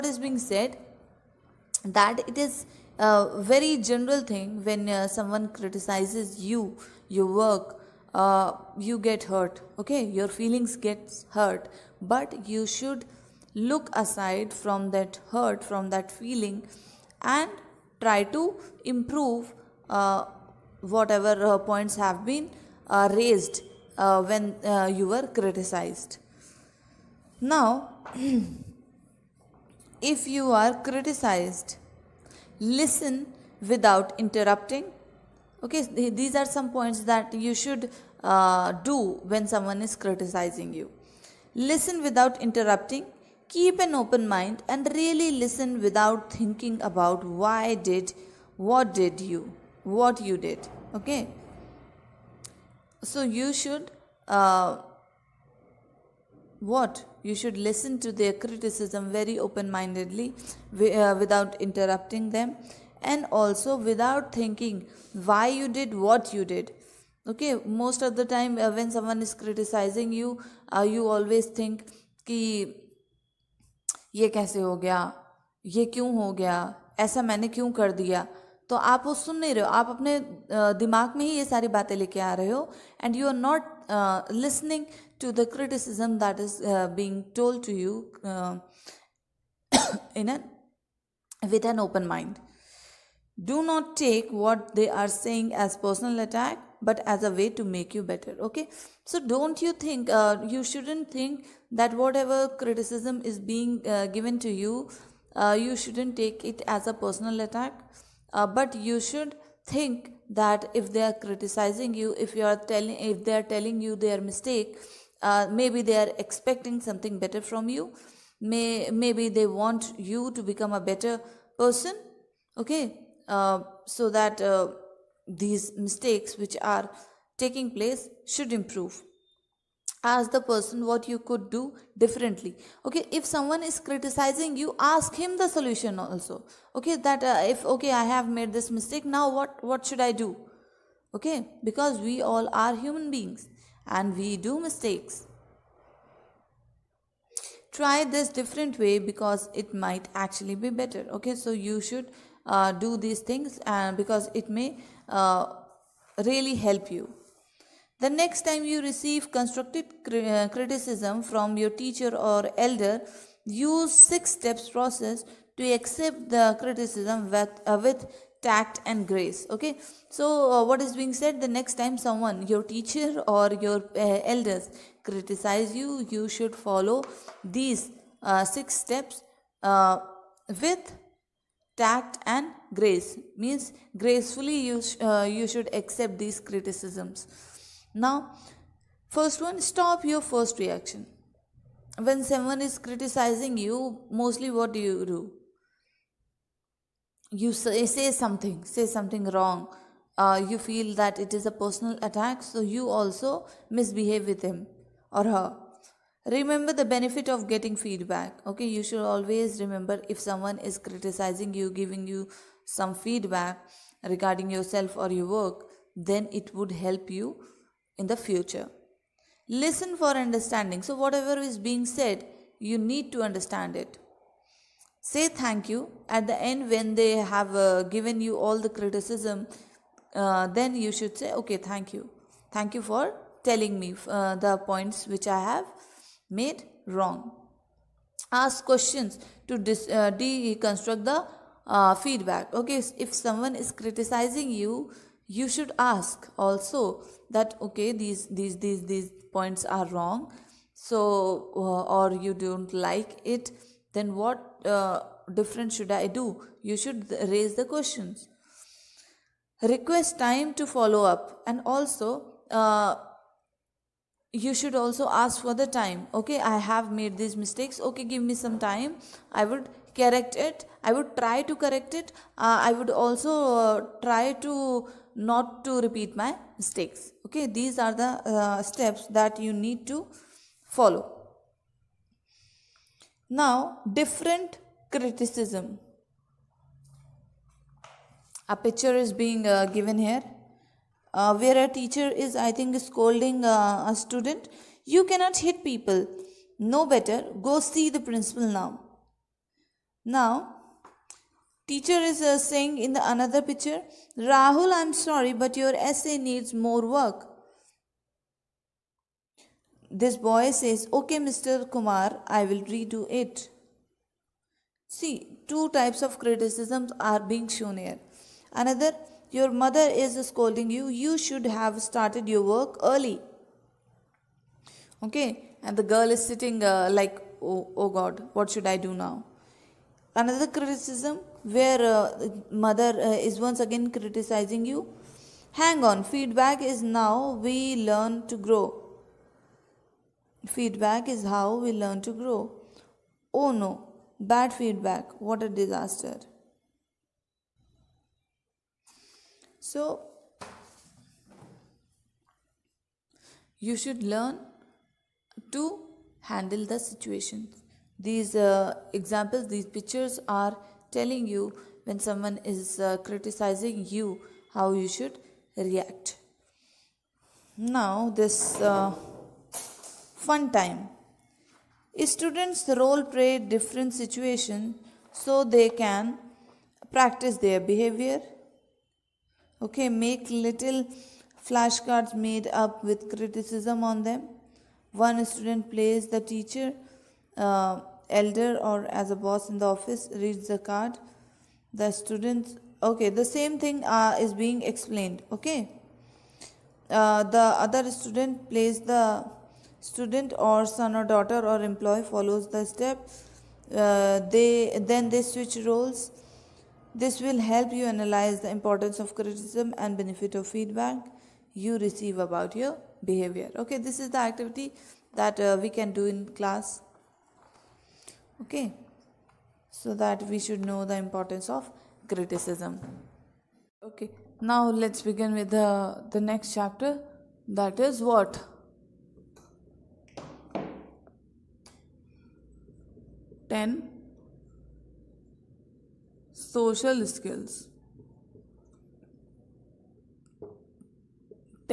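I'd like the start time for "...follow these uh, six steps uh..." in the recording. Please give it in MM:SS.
02:56.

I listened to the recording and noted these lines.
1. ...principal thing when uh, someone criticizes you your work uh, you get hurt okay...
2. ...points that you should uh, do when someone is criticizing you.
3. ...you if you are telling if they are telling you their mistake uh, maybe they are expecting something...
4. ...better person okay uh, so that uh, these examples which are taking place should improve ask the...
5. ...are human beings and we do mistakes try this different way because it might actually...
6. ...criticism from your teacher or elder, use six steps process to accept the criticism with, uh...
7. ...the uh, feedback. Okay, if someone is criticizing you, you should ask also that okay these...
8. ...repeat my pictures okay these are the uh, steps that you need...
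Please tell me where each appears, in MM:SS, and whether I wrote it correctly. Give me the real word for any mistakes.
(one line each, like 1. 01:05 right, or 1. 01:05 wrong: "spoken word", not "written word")
1. 00:03 wrong: "general", not "principal"
2. 00:36 right
3. 01:51 right
4. 02:00 wrong: "mistakes", not "examples"
5. 02:22 right
6. 02:40 right
7. 04:01 right
8. 04:35 wrong: "mistakes", not "pictures".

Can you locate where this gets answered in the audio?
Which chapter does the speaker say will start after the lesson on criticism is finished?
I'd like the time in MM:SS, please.
07:13.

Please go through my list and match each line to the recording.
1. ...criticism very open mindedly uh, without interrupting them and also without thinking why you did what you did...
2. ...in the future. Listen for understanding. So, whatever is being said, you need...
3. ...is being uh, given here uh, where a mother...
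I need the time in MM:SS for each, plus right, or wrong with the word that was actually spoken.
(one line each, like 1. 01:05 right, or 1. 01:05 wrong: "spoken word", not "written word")
1. 00:58 right
2. 03:37 right
3. 04:48 wrong: "teacher", not "mother".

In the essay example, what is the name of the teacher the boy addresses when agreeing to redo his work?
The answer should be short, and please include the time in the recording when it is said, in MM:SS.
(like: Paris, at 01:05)
Mr. Kumar, at 05:11.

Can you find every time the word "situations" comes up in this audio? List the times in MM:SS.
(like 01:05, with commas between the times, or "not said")
05:56, 06:13.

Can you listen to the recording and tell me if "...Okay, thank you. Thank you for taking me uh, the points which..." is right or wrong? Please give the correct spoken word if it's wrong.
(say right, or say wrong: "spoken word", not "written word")
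wrong: "telling", not "taking".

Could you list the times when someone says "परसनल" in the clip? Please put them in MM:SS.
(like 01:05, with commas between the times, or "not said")
01:35, 01:47.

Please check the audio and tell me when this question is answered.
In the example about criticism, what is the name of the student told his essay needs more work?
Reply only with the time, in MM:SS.
05:04.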